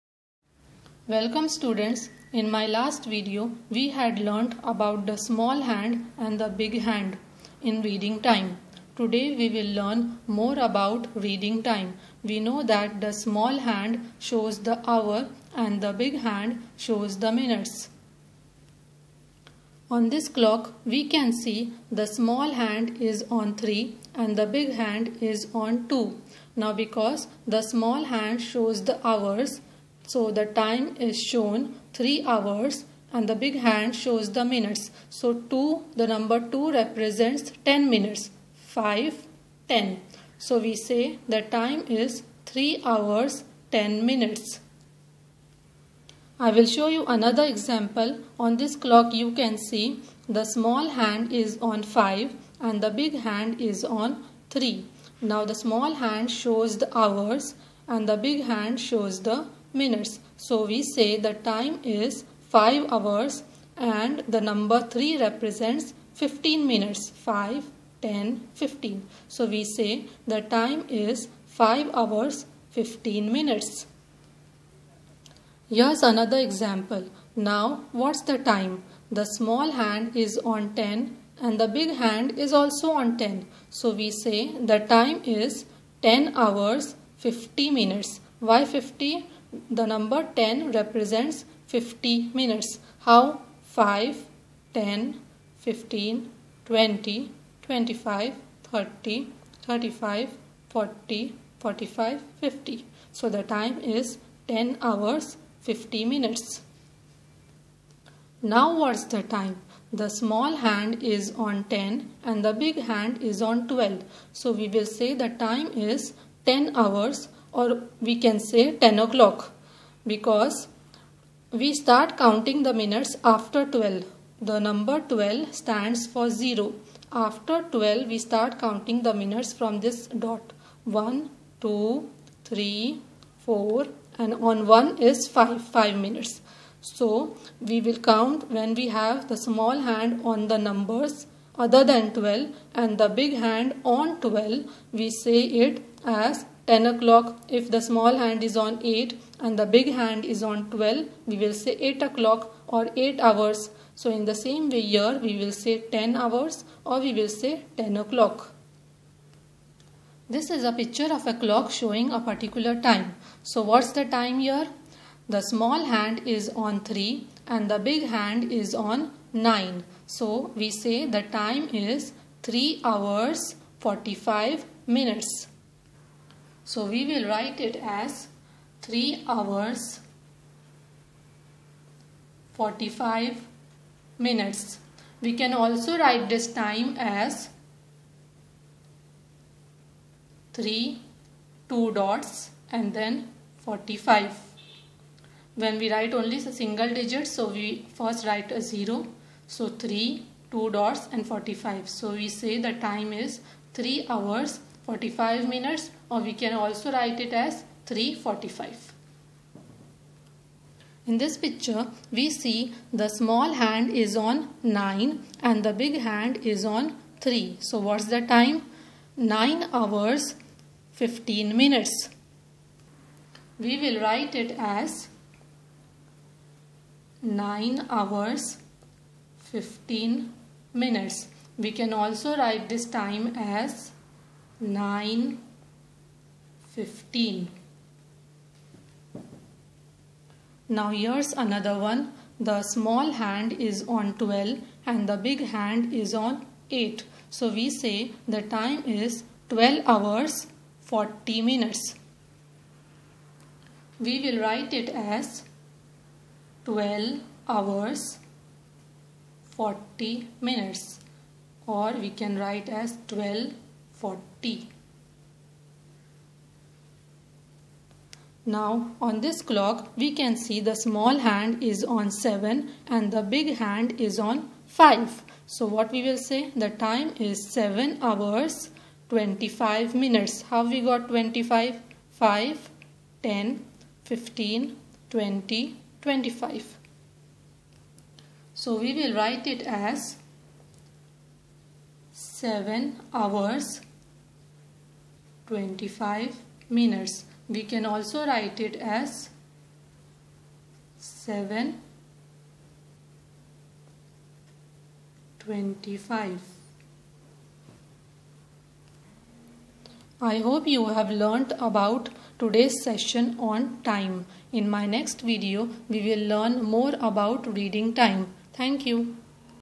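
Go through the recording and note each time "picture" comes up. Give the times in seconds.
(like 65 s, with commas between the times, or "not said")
160 s, 211 s.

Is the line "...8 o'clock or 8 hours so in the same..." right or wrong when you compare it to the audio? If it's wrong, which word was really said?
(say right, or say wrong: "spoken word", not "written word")
right.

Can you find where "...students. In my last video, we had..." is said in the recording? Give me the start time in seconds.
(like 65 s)
1 s.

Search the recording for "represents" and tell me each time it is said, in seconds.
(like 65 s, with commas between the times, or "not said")
36 s, 65 s, 90 s.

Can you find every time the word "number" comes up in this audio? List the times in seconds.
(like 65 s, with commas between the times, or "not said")
36 s, 64 s, 89 s, 124 s, 140 s.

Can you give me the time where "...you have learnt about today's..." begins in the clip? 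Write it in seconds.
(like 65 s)
310 s.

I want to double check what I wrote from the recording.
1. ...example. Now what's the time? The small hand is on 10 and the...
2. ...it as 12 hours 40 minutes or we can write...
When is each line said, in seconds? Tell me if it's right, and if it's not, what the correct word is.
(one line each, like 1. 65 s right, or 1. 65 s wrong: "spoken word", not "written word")
1. 76 s right
2. 254 s right.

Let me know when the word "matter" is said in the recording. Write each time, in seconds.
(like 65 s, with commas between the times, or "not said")
not said.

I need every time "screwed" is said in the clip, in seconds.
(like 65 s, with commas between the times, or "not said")
not said.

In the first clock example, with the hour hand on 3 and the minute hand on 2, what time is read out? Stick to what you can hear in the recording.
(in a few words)
3 hours 10 minutes.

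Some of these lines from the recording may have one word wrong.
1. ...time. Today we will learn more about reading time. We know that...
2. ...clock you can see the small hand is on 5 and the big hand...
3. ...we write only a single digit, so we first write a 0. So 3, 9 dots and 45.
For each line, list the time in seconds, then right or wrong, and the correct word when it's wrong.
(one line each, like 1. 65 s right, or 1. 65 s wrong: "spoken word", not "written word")
1. 8 s right
2. 48 s right
3. 195 s wrong: "2", not "9".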